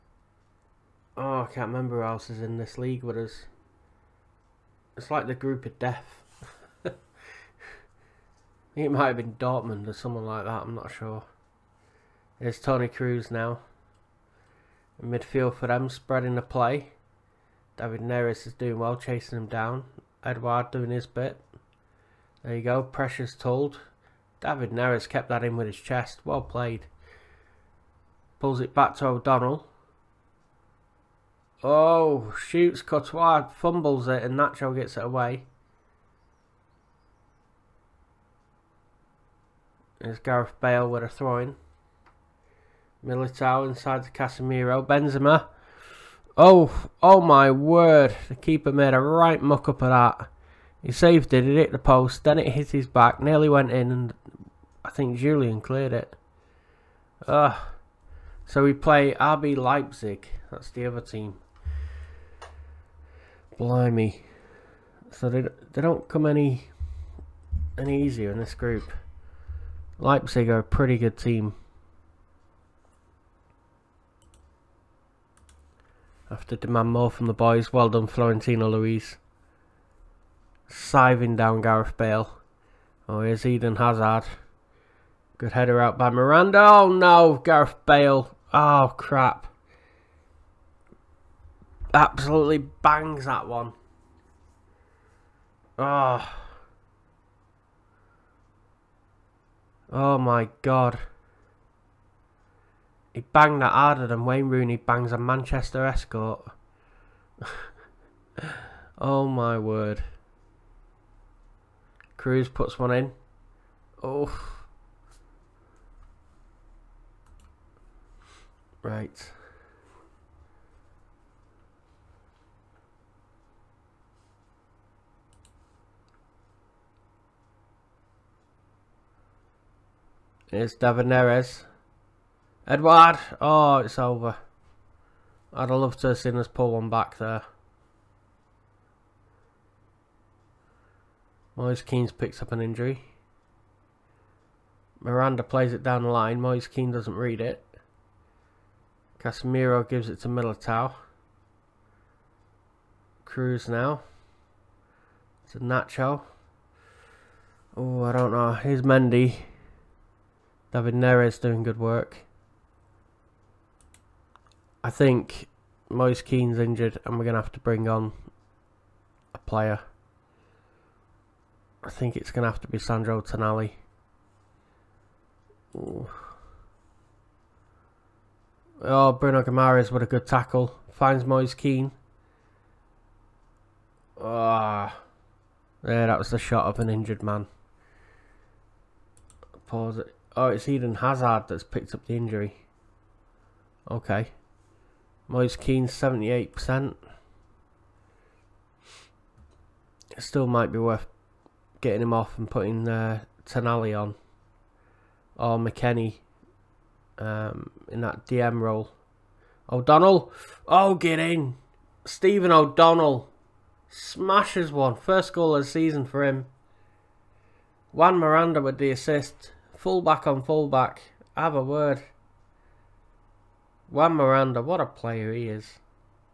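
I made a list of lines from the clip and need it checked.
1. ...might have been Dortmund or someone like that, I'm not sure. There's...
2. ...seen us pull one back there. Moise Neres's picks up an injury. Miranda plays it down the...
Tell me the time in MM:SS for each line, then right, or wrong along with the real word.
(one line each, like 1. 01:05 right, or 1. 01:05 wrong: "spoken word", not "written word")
1. 00:08 right
2. 02:16 wrong: "Kean", not "Neres".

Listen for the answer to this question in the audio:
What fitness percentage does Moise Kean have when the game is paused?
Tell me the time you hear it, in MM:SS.
03:15.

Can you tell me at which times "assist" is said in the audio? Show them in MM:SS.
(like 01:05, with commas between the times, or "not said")
03:38.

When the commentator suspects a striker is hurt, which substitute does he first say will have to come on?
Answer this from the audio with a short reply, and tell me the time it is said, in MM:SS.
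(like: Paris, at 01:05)
Sandro Tonali, at 02:52.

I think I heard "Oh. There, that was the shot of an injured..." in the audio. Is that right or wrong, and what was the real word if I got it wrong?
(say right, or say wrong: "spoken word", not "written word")
right.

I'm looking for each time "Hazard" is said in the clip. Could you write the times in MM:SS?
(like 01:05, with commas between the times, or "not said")
01:23, 03:10.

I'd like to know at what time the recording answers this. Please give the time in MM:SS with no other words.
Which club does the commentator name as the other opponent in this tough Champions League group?
00:59.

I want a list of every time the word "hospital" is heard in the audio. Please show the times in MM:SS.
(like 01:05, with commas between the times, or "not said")
not said.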